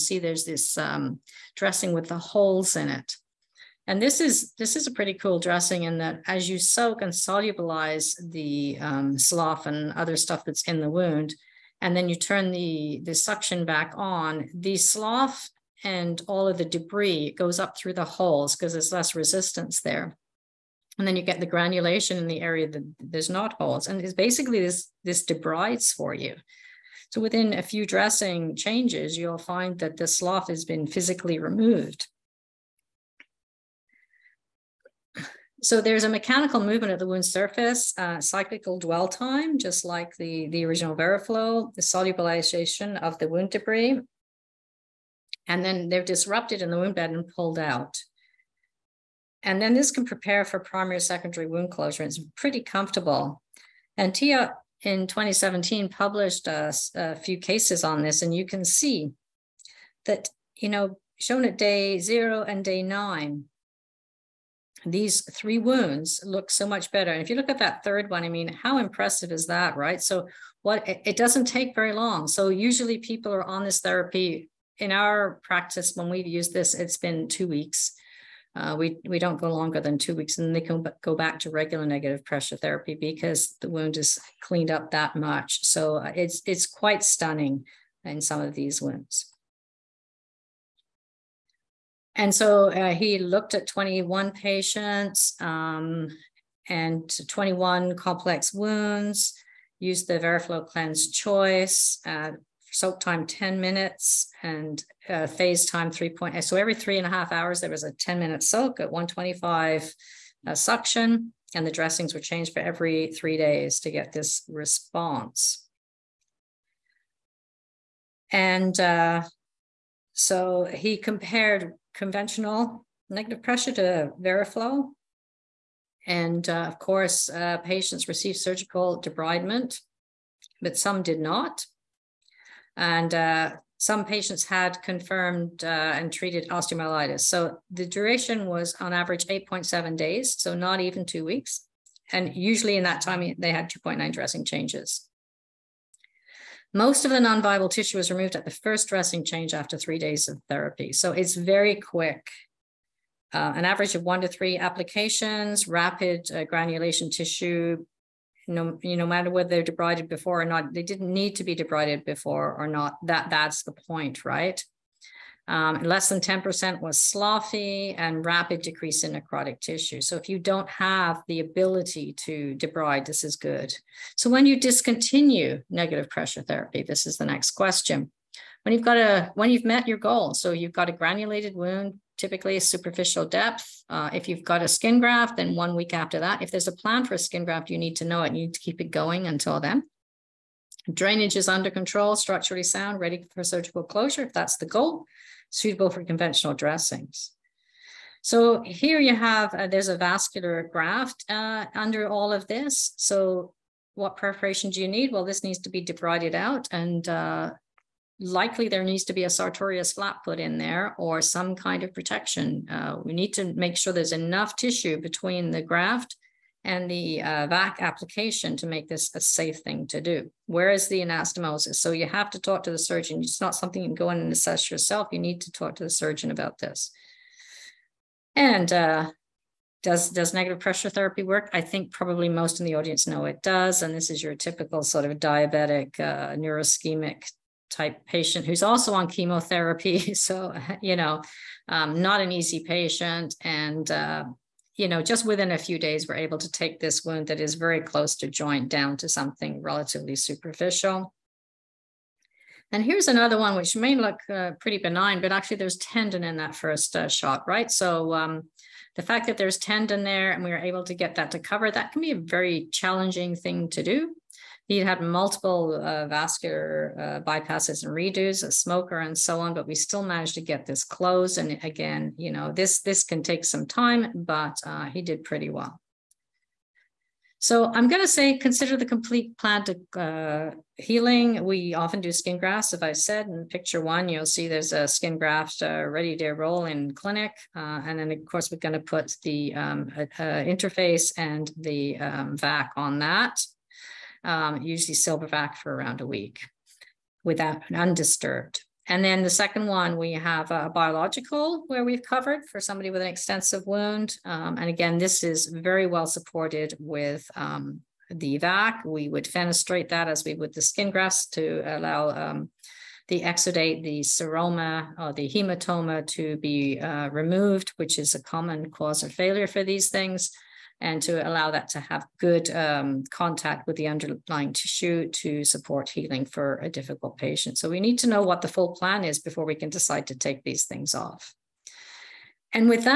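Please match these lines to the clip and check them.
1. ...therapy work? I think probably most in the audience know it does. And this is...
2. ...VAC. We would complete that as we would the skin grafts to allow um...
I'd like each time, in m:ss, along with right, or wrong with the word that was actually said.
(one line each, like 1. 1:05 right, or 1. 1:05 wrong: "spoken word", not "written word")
1. 3:50 right
2. 5:08 wrong: "fenestrate", not "complete".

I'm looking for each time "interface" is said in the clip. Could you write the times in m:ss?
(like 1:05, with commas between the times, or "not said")
4:50.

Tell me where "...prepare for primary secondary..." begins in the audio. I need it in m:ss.
0:50.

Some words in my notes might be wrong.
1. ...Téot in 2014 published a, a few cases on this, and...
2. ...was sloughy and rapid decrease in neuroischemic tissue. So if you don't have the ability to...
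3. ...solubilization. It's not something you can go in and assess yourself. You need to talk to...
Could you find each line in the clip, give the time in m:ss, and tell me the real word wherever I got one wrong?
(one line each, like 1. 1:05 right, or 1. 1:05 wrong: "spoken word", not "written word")
1. 0:54 wrong: "2017", not "2014"
2. 2:46 wrong: "necrotic", not "neuroischemic"
3. 3:42 wrong: "surgeon", not "solubilization".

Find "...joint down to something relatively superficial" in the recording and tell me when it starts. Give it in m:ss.
4:08.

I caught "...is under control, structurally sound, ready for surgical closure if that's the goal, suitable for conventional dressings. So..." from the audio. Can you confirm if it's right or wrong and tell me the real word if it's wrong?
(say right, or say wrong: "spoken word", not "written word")
right.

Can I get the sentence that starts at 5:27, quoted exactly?
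So we need to know what the full plan is before we can decide to take these things off.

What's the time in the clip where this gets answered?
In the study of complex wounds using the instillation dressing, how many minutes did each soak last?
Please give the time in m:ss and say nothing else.
1:43.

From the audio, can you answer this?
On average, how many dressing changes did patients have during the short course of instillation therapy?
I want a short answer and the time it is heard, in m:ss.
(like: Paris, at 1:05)
2.9, at 2:23.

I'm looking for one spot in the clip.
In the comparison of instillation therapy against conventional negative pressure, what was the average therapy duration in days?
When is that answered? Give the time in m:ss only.
2:19.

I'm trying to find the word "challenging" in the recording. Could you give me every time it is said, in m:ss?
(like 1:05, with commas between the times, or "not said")
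4:22.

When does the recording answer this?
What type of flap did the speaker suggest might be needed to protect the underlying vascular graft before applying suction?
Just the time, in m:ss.
3:29.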